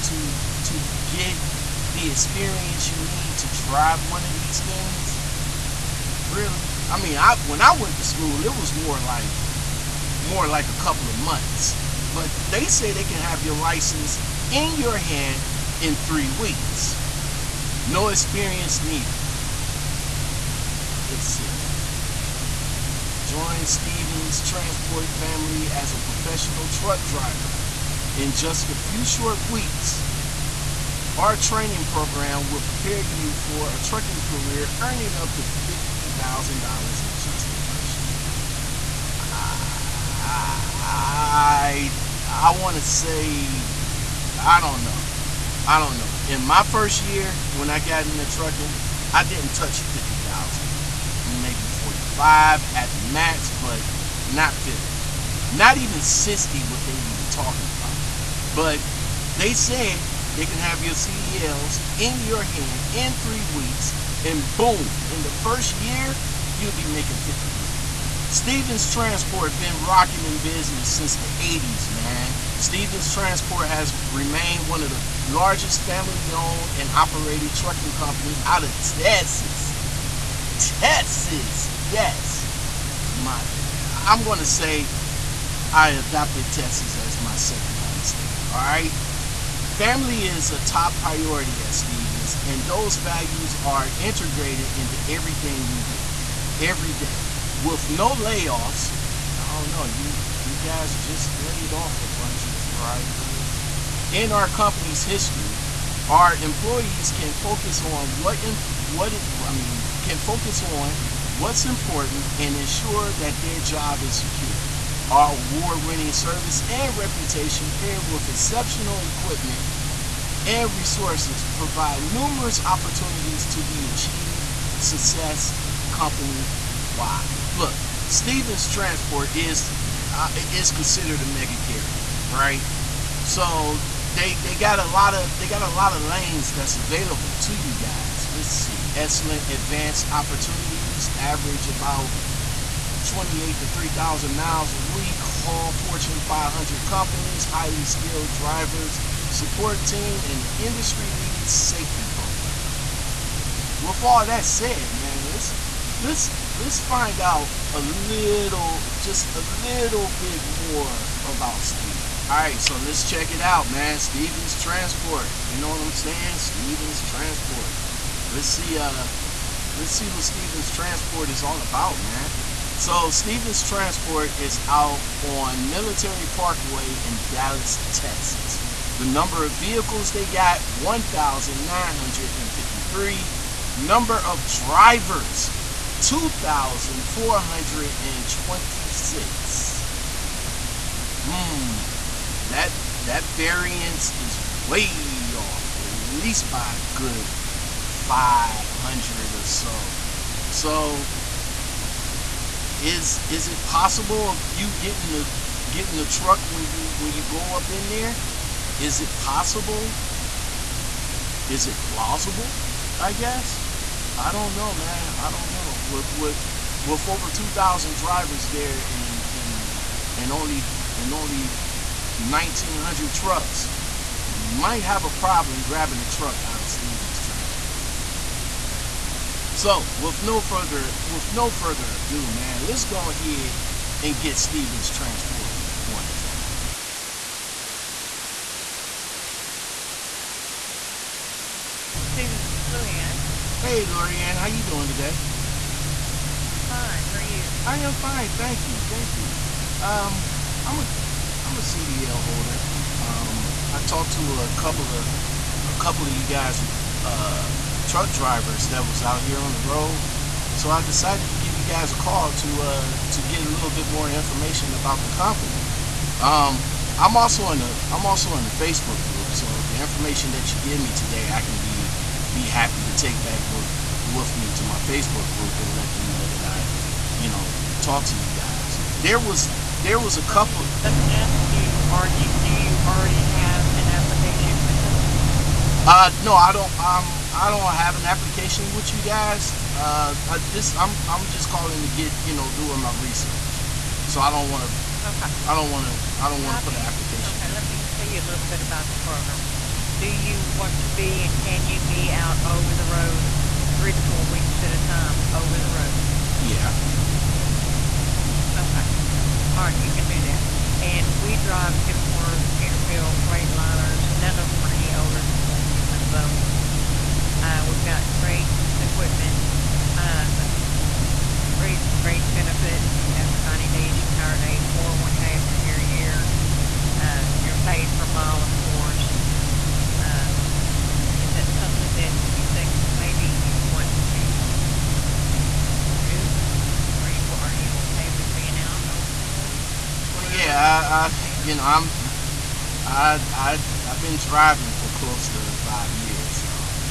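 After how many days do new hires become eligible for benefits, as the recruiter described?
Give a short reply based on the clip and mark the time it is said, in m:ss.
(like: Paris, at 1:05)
90 days, at 5:23.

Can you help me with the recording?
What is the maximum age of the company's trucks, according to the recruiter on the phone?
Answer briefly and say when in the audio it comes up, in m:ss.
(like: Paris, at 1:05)
14 months, at 5:15.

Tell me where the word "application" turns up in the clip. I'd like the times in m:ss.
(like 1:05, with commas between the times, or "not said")
4:43, 4:48, 4:56.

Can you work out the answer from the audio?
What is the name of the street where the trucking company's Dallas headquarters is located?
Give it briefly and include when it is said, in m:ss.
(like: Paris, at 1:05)
Military Parkway, at 2:55.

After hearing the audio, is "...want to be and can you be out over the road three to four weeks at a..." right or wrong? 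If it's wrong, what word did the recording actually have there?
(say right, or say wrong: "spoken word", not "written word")
right.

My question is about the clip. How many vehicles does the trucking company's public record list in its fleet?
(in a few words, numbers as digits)
1,953.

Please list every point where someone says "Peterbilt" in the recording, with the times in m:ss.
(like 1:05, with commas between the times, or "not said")
5:12.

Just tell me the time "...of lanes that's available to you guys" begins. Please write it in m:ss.
2:15.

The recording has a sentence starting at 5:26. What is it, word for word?
Uh, you're paid per mile, of course.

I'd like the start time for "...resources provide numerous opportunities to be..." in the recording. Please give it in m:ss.
2:00.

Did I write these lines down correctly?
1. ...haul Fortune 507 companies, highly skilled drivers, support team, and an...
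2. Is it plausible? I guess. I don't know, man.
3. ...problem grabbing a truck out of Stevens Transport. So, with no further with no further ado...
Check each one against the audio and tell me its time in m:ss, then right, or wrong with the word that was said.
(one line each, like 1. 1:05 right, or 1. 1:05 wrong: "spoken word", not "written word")
1. 2:25 wrong: "500", not "507"
2. 3:31 right
3. 3:45 right.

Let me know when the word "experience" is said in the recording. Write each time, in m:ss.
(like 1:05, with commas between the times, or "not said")
0:02, 0:18.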